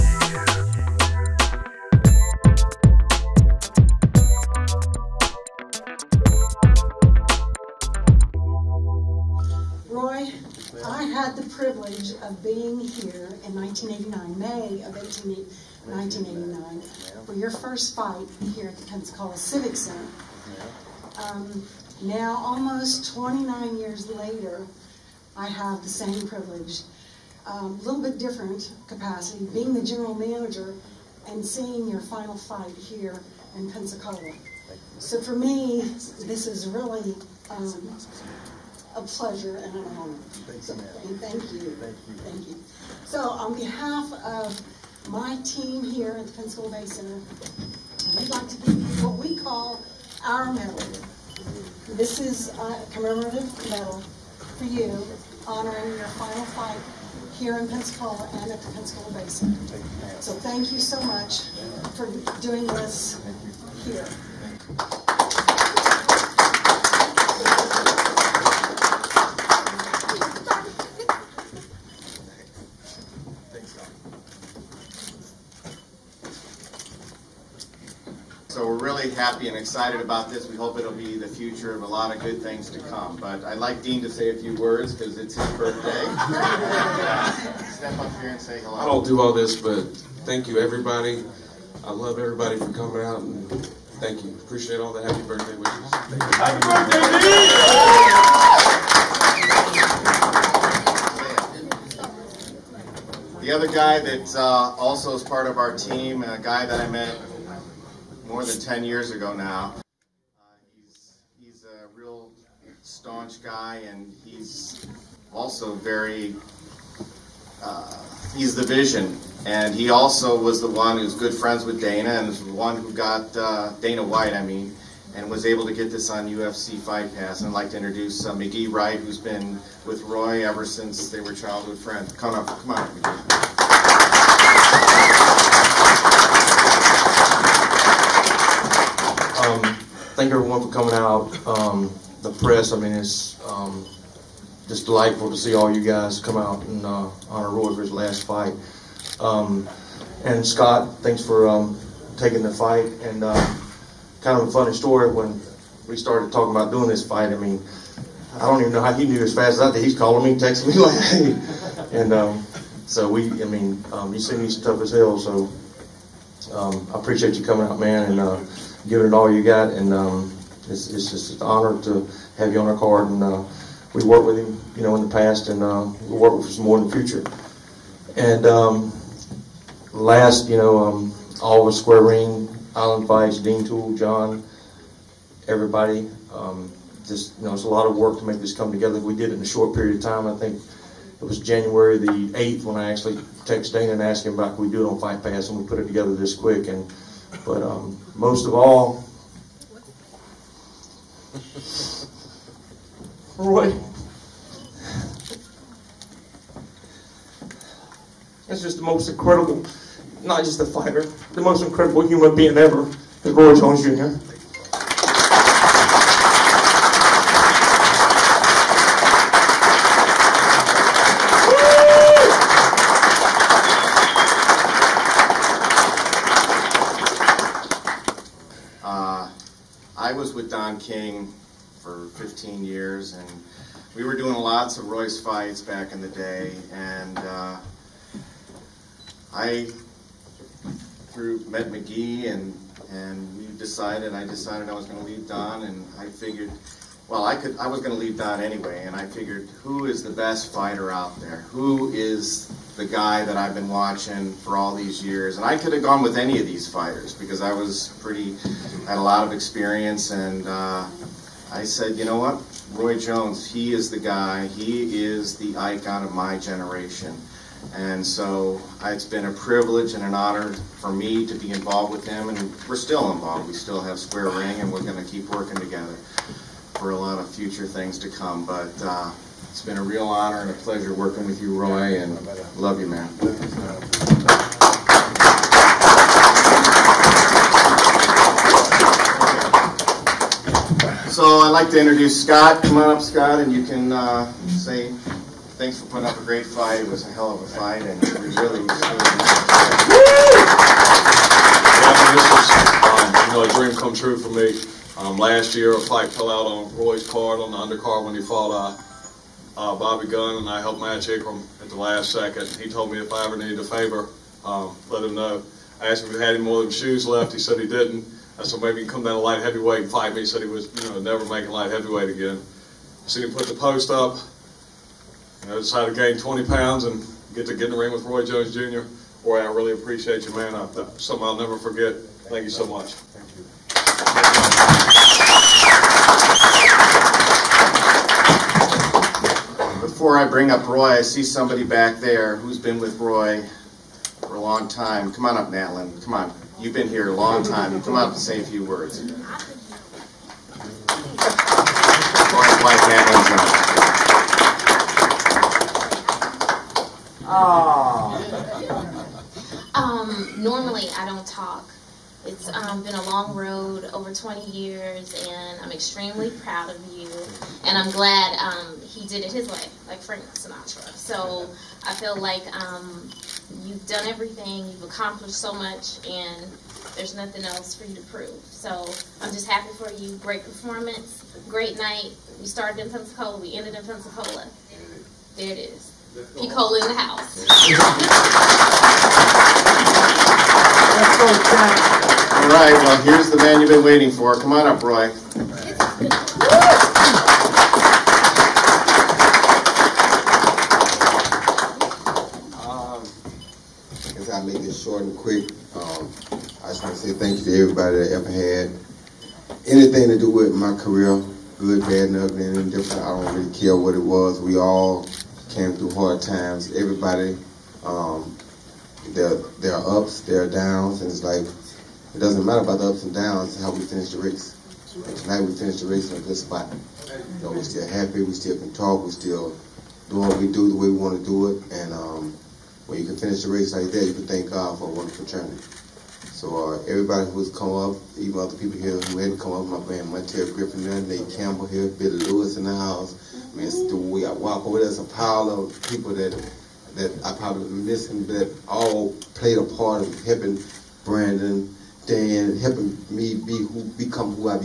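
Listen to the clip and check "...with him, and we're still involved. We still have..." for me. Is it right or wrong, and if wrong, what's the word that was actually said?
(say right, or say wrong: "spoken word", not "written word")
right.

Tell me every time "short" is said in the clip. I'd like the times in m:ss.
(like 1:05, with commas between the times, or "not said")
3:09, 6:44.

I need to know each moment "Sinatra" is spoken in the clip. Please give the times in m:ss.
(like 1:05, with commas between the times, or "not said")
6:10.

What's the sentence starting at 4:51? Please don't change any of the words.
So I'd like to introduce Scott.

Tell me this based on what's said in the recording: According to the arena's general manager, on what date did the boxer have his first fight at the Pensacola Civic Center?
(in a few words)
May 18, 1989.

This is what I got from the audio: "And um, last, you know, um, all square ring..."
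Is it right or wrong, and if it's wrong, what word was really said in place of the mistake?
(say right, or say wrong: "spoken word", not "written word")
right.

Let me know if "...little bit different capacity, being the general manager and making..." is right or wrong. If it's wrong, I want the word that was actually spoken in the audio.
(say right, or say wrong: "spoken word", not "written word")
wrong: "seeing", not "making".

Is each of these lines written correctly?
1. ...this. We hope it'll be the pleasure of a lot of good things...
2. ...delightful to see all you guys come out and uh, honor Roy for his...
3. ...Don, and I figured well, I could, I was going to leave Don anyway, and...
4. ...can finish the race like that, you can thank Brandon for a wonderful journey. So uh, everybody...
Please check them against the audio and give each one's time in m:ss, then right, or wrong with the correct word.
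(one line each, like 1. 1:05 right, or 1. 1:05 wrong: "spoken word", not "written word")
1. 1:20 wrong: "future", not "pleasure"
2. 2:24 right
3. 4:05 right
4. 7:13 wrong: "God", not "Brandon".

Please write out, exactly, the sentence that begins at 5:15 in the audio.
I asked him if he had any more than shoes left.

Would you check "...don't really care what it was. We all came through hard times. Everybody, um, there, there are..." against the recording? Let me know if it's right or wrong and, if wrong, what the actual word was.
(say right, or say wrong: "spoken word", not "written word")
right.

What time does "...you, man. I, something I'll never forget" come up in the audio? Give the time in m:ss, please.
5:30.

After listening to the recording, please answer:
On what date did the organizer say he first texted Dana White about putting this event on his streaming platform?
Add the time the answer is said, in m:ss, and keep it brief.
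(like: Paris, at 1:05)
January 8, at 3:11.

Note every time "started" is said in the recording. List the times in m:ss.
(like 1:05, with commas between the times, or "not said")
2:35, 6:22.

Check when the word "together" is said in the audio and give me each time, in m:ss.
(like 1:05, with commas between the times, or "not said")
3:08, 3:15, 4:35.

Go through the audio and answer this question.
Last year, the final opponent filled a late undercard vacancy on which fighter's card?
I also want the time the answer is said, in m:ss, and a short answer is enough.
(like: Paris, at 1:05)
Bobby Gunn, at 5:09.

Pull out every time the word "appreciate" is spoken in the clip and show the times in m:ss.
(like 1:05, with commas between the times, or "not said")
1:34, 2:46, 5:29.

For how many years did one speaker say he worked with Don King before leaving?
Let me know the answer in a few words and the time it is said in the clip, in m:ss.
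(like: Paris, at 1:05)
15, at 3:52.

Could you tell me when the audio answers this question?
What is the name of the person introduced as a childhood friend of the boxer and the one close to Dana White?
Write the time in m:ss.
2:08.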